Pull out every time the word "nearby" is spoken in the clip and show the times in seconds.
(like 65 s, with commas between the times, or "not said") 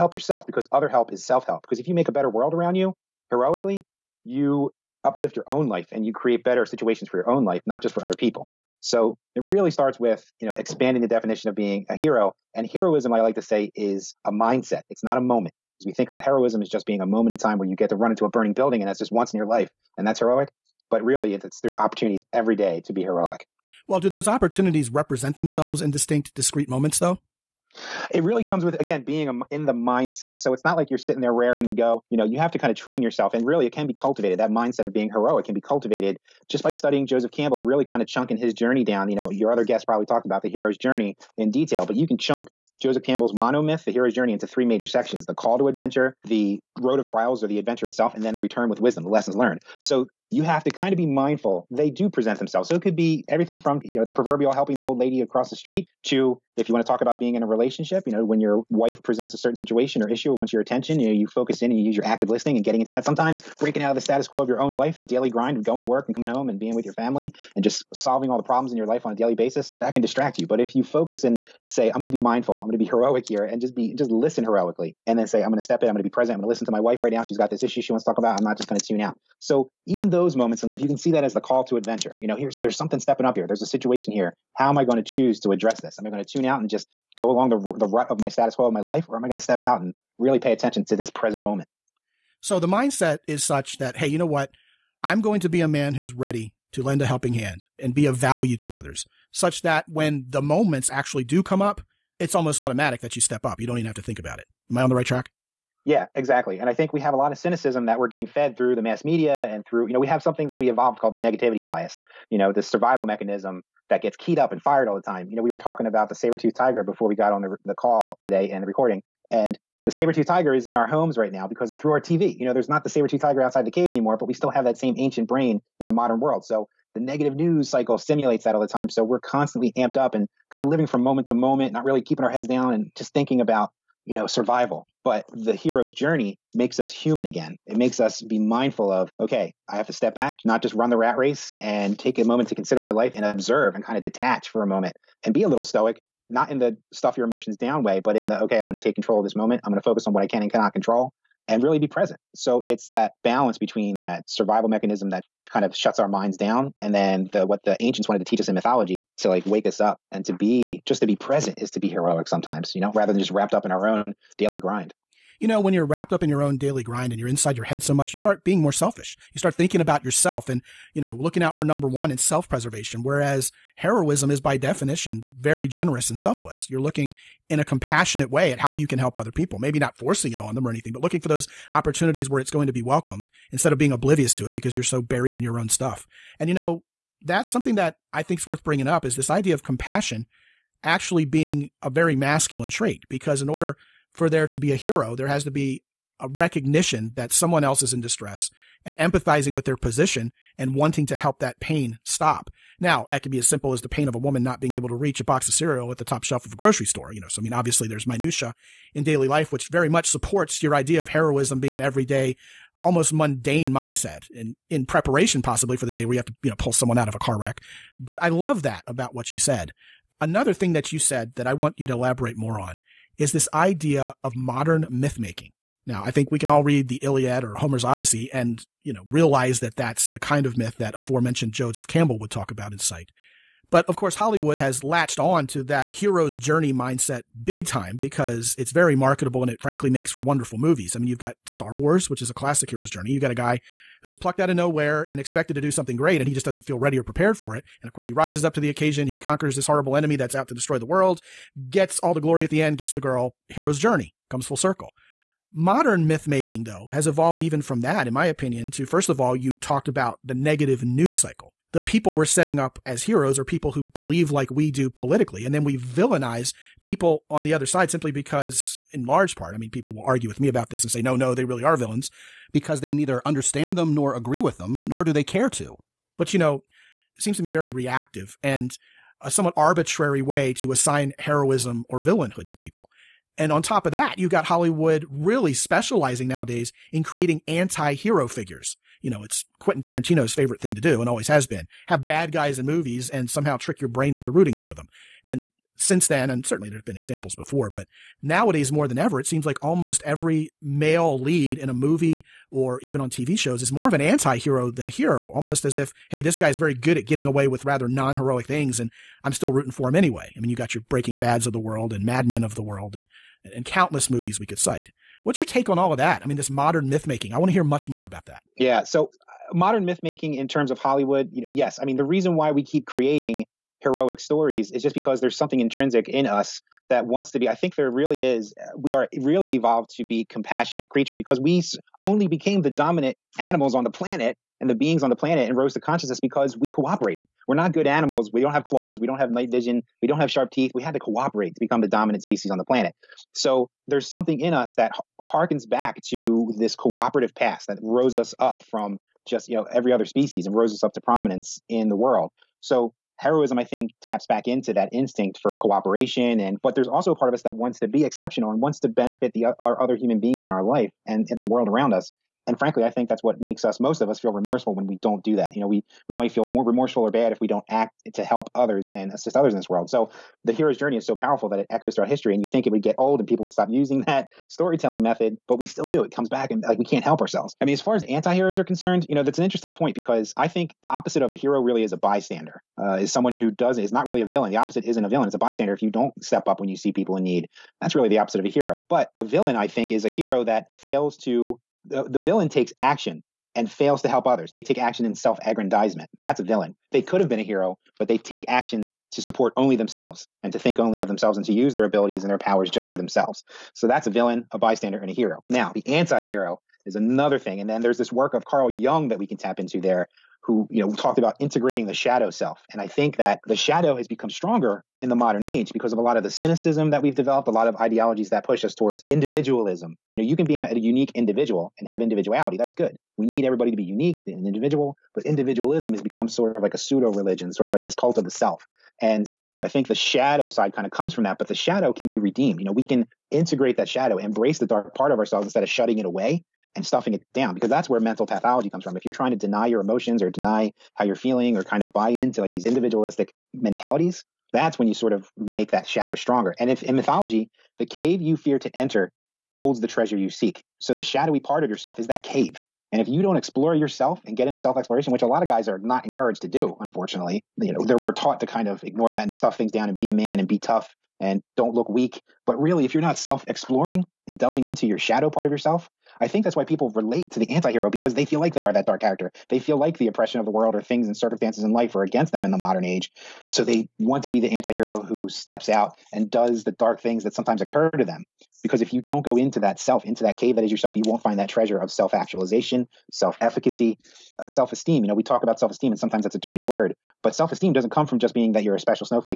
not said.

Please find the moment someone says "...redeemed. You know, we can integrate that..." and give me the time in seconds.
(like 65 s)
432 s.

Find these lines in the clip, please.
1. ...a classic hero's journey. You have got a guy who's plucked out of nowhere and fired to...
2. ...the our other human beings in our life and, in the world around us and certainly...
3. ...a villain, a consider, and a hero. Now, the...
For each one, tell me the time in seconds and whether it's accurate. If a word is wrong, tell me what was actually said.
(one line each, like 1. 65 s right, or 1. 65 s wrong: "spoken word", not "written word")
1. 242 s wrong: "expected", not "fired"
2. 359 s wrong: "frankly", not "certainly"
3. 404 s wrong: "bystander", not "consider".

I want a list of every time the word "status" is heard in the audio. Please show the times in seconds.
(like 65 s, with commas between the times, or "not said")
64 s, 88 s.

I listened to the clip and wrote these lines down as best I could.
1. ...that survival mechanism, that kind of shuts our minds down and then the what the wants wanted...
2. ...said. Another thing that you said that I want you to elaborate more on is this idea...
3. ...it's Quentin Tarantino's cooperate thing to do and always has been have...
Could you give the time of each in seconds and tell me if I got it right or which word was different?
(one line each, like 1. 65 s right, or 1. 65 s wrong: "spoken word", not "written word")
1. 154 s wrong: "ancients", not "wants"
2. 219 s right
3. 289 s wrong: "favorite", not "cooperate".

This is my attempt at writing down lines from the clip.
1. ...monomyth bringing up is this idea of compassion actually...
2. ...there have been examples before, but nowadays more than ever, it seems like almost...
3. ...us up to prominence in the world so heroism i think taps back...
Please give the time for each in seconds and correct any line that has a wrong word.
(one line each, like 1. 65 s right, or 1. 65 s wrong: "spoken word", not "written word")
1. 188 s wrong: "worth", not "monomyth"
2. 296 s right
3. 350 s right.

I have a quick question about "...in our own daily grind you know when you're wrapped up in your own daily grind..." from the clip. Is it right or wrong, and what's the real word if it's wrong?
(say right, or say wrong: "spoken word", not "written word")
right.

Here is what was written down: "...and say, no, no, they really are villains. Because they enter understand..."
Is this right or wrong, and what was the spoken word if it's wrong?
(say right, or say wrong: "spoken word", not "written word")
wrong: "neither", not "enter".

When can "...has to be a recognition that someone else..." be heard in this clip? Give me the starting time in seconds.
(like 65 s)
195 s.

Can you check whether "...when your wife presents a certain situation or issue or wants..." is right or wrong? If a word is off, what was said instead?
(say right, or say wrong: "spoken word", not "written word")
right.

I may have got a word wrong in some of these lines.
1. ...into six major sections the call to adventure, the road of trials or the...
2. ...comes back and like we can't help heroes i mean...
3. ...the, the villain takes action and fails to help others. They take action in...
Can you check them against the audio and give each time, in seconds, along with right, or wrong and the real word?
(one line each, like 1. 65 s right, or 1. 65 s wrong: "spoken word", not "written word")
1. 44 s wrong: "three", not "six"
2. 376 s wrong: "ourselves", not "heroes"
3. 391 s right.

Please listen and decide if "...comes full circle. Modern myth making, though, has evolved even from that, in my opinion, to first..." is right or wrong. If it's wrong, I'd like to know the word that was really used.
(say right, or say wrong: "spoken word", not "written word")
right.